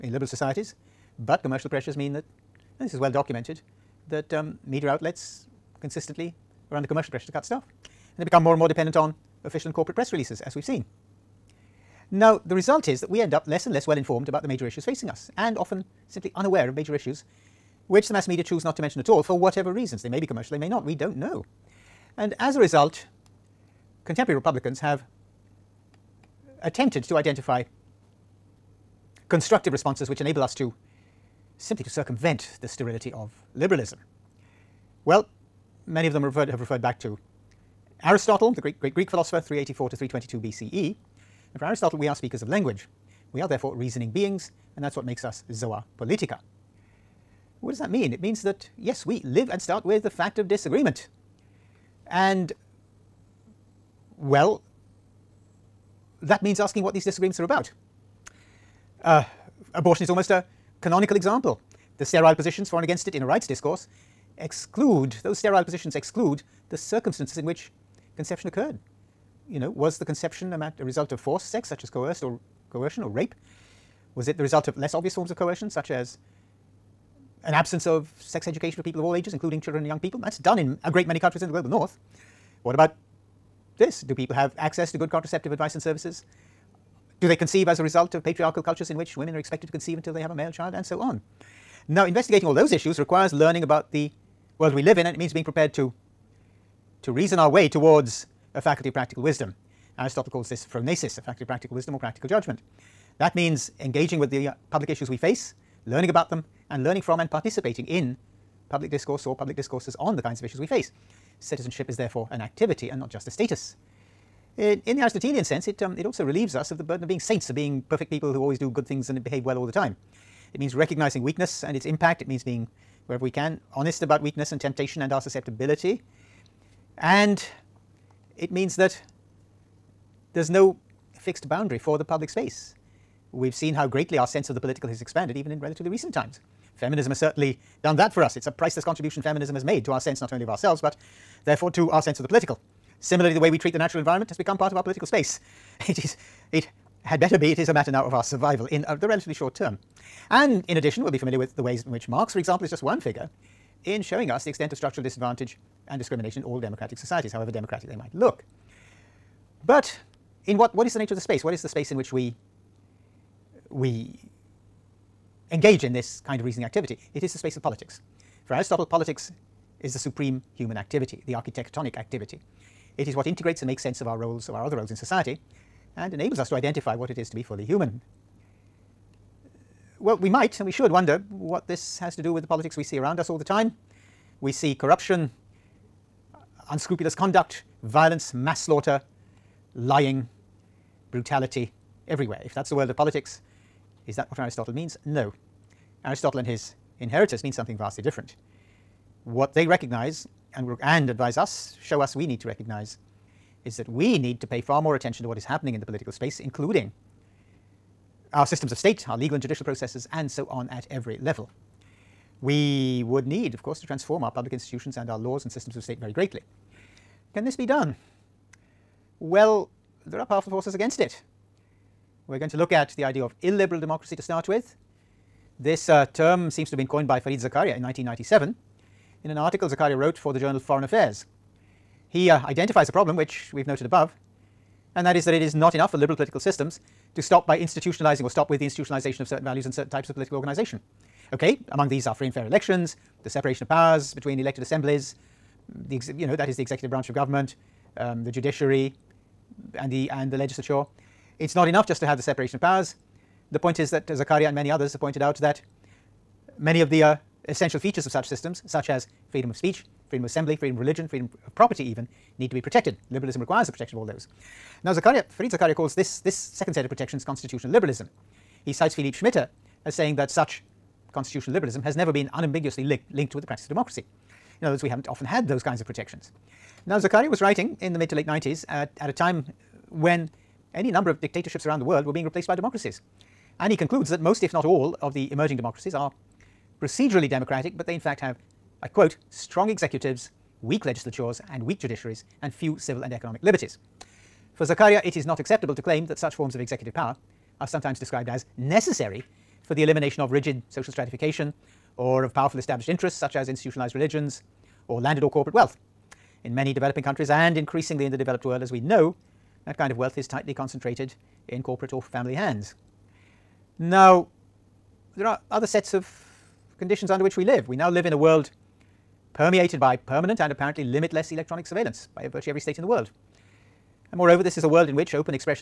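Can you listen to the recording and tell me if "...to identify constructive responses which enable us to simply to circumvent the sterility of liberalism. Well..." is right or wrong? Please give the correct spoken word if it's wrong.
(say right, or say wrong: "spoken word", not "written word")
right.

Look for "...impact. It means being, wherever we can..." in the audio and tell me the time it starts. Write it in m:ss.
2:01.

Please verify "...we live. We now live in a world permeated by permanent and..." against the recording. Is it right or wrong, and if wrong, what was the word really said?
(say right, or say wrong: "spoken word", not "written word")
right.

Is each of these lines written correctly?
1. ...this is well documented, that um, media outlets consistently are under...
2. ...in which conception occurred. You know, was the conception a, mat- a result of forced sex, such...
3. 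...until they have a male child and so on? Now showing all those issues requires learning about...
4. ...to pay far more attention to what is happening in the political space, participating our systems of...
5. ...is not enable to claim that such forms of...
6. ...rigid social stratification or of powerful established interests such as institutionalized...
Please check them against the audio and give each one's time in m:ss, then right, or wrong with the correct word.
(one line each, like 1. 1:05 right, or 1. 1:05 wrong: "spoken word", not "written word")
1. 0:02 right
2. 1:07 right
3. 1:29 wrong: "investigating", not "showing"
4. 3:24 wrong: "including", not "participating"
5. 4:55 wrong: "acceptable", not "enable"
6. 5:00 right.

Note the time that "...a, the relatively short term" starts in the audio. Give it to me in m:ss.
2:28.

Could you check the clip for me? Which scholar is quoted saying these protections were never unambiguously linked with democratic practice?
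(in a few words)
Philippe Schmitter.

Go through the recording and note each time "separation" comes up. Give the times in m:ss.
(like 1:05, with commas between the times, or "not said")
4:03, 4:12.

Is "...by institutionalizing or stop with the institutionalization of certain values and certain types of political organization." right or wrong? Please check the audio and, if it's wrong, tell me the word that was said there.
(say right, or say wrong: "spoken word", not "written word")
right.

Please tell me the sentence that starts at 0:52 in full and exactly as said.
And, well, that means asking what these disagreements are about.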